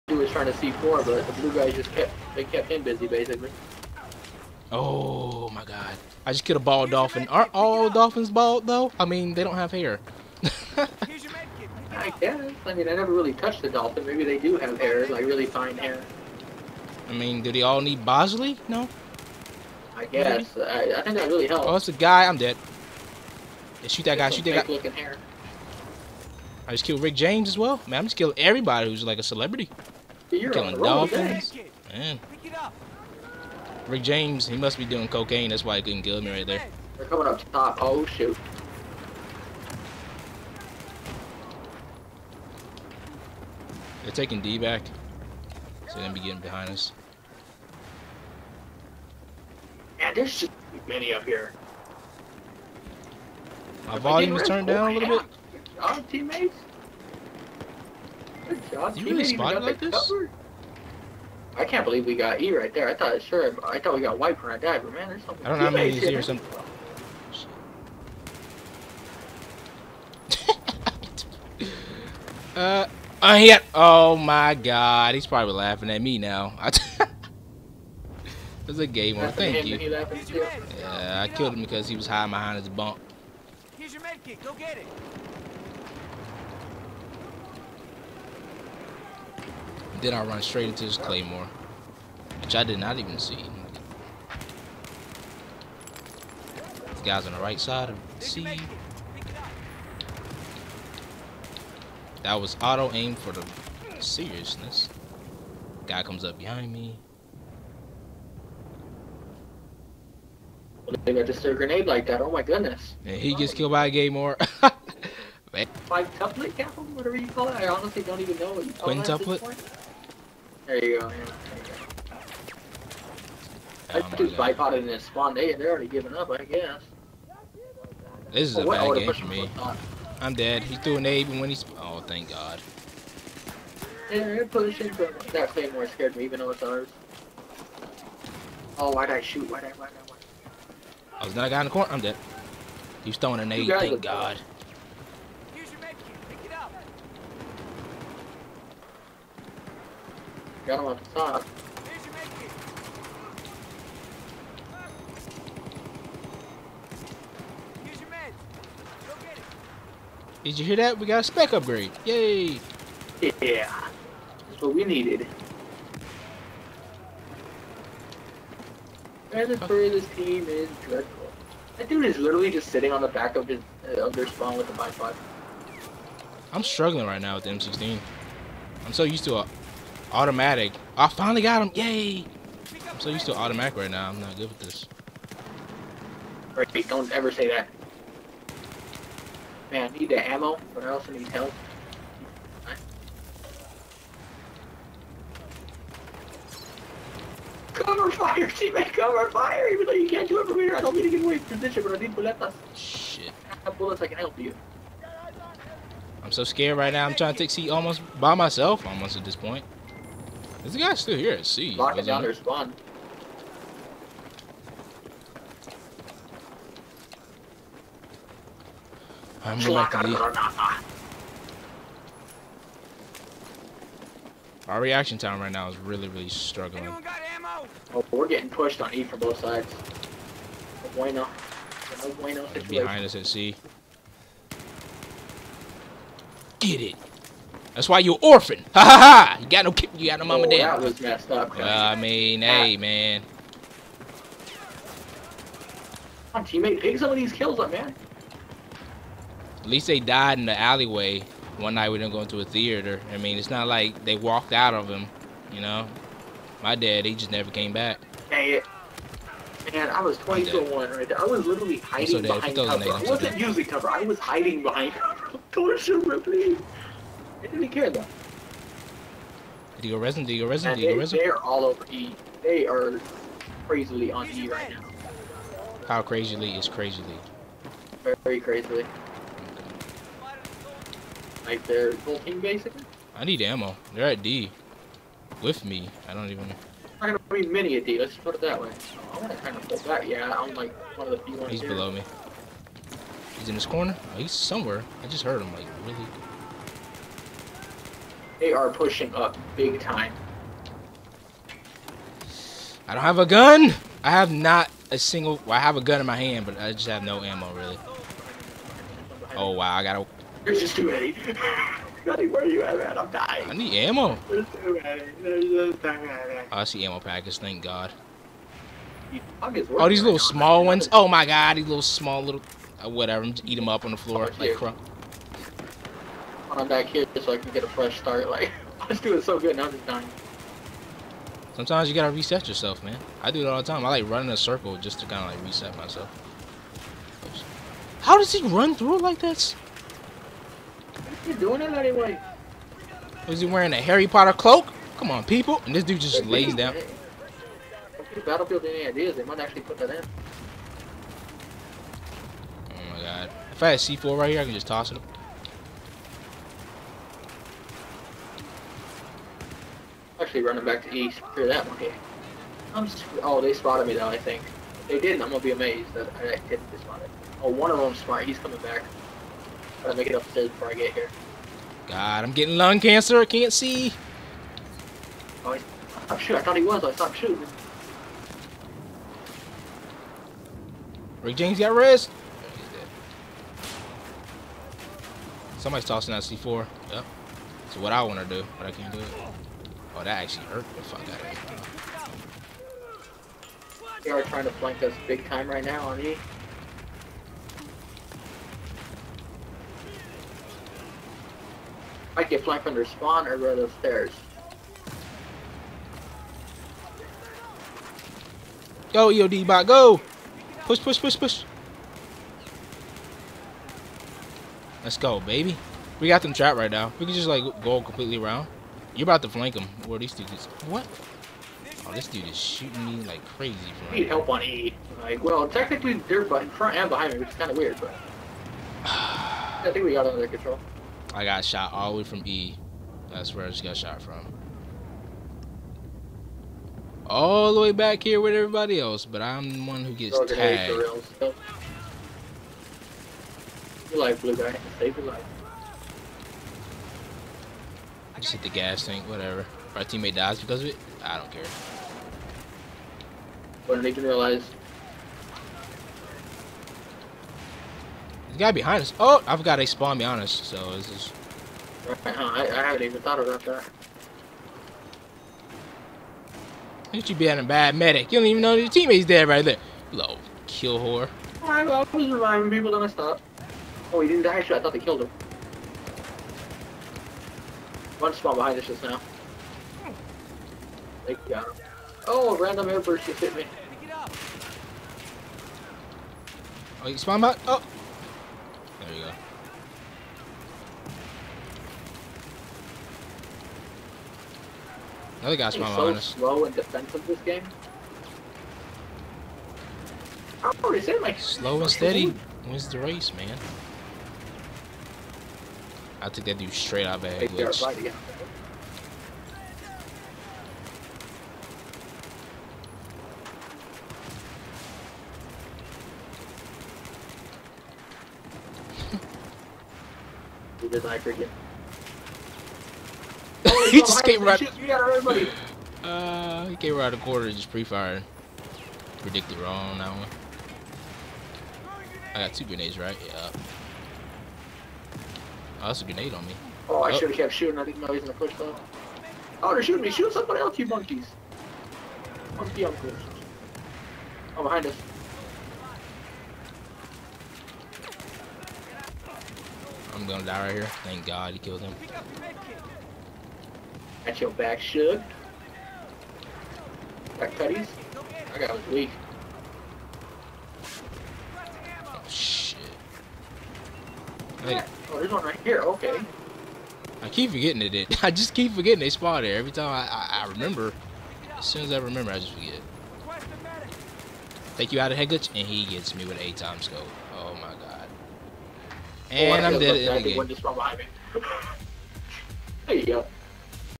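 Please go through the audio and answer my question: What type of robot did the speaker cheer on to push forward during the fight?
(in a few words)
EOD bot.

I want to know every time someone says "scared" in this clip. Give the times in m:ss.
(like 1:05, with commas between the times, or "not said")
2:15, 3:26.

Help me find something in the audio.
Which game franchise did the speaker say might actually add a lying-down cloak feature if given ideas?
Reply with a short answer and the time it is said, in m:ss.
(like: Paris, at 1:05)
Battlefield, at 5:48.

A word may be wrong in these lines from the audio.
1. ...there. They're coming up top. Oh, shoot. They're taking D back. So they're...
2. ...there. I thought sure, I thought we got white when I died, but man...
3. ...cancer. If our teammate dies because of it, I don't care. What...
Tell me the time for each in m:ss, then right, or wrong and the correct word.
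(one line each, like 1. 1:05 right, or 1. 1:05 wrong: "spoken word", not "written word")
1. 0:36 right
2. 1:02 right
3. 7:29 wrong: "whatever", not "cancer".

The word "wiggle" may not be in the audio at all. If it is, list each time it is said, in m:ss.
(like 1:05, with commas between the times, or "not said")
not said.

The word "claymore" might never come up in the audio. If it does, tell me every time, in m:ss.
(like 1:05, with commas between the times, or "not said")
1:30, 1:53.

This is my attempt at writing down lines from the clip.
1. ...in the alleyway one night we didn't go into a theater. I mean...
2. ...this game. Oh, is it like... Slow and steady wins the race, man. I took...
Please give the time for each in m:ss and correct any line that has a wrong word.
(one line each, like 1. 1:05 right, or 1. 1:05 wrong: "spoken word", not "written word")
1. 4:10 right
2. 8:17 right.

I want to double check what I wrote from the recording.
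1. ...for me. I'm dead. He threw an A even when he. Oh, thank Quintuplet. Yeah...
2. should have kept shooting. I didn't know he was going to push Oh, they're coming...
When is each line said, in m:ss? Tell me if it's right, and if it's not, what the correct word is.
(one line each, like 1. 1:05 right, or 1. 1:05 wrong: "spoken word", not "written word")
1. 2:09 wrong: "God", not "Quintuplet"
2. 8:56 wrong: "shooting", not "coming".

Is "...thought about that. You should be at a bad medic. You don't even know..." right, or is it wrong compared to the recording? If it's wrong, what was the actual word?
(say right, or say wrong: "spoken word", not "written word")
right.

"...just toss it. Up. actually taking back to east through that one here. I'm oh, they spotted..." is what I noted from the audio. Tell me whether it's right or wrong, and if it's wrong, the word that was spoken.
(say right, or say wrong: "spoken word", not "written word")
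wrong: "running", not "taking".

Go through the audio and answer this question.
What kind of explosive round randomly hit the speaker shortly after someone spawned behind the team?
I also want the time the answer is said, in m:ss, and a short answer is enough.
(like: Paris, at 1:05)
airburst, at 8:02.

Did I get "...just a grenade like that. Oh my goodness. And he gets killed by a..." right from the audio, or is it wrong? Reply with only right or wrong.
right.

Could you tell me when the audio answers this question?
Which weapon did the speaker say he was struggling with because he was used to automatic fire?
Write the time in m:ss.
2:57.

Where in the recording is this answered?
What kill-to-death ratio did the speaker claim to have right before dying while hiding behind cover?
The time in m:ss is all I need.
4:20.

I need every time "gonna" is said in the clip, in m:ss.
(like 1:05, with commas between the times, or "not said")
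4:47, 6:05, 9:10.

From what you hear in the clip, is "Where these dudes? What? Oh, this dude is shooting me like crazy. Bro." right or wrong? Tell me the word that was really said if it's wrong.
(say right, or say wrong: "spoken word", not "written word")
right.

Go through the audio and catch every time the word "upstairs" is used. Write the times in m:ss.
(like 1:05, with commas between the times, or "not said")
6:10, 6:43.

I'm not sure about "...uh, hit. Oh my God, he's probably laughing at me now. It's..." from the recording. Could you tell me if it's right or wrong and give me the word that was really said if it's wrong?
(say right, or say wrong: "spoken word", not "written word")
right.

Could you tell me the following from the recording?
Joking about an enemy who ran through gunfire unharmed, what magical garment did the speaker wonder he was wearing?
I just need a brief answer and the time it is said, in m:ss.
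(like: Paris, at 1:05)
Harry Potter cloak, at 5:43.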